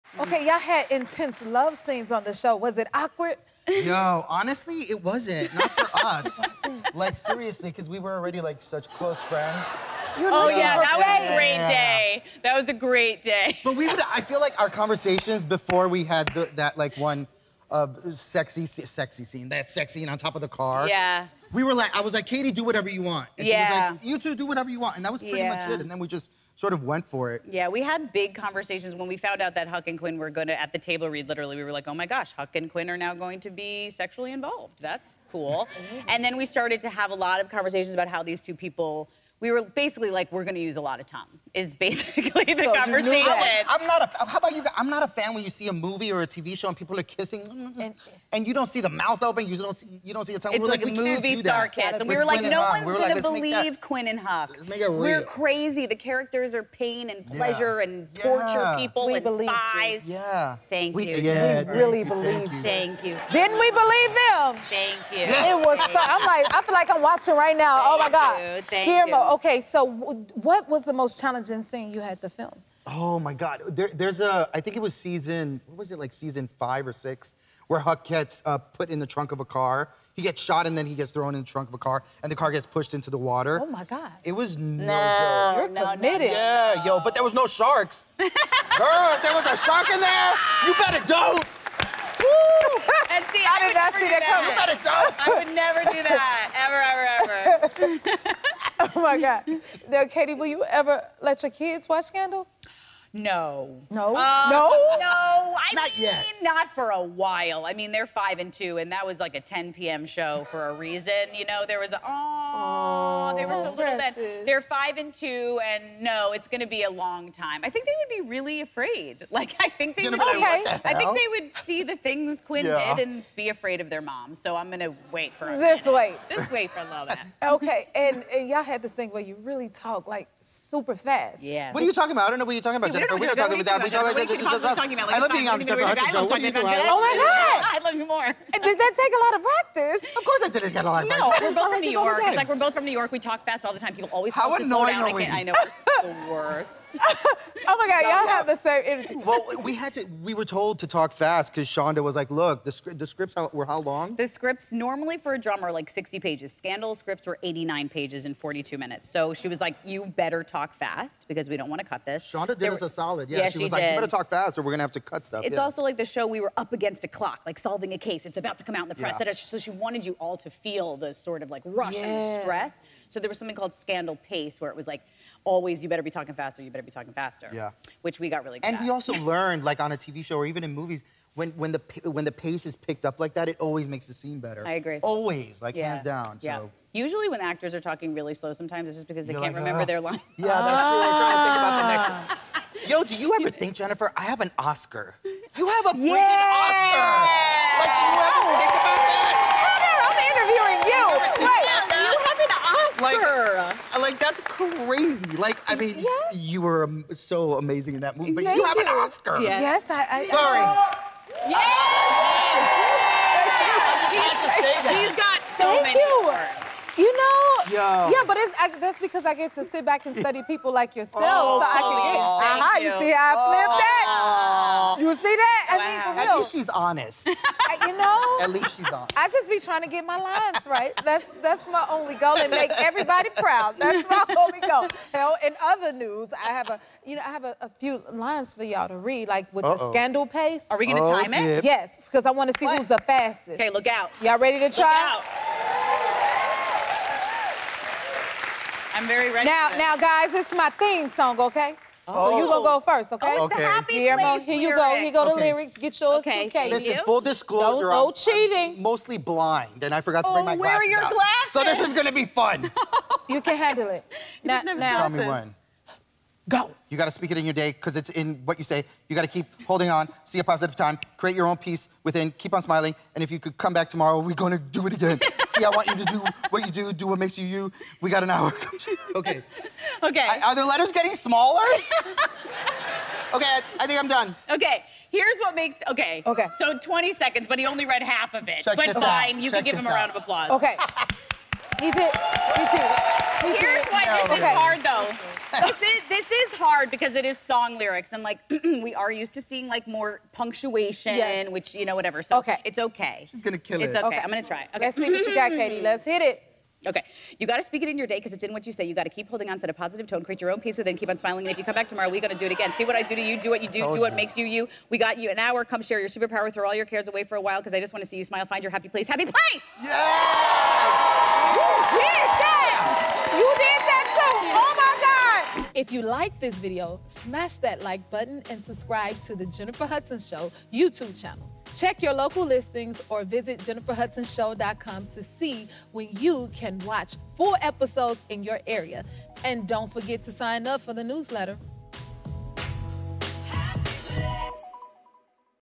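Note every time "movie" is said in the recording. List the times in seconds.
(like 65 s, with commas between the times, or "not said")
45 s, 51 s, 180 s, 208 s.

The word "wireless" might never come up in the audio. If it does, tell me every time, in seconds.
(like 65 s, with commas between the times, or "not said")
not said.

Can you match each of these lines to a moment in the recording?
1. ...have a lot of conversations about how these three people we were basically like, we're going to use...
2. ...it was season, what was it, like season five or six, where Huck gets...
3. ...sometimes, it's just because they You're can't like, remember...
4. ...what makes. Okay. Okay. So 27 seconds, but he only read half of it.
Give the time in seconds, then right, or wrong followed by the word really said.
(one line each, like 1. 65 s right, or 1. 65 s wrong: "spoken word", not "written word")
1. 36 s wrong: "two", not "three"
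2. 74 s right
3. 188 s right
4. 285 s wrong: "20", not "27".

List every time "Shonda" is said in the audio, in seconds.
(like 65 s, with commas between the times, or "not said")
151 s, 162 s.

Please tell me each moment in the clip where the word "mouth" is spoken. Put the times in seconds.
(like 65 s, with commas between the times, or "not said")
48 s.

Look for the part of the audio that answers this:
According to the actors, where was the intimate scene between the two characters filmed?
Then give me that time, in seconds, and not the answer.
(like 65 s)
20 s.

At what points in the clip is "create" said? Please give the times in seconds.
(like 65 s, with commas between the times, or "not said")
271 s, 310 s.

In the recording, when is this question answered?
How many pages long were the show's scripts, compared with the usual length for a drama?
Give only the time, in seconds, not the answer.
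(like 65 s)
157 s.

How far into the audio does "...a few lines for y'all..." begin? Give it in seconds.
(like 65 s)
237 s.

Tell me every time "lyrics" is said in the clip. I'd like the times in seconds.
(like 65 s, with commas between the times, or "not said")
255 s, 297 s.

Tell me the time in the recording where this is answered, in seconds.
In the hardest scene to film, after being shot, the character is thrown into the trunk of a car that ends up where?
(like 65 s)
83 s.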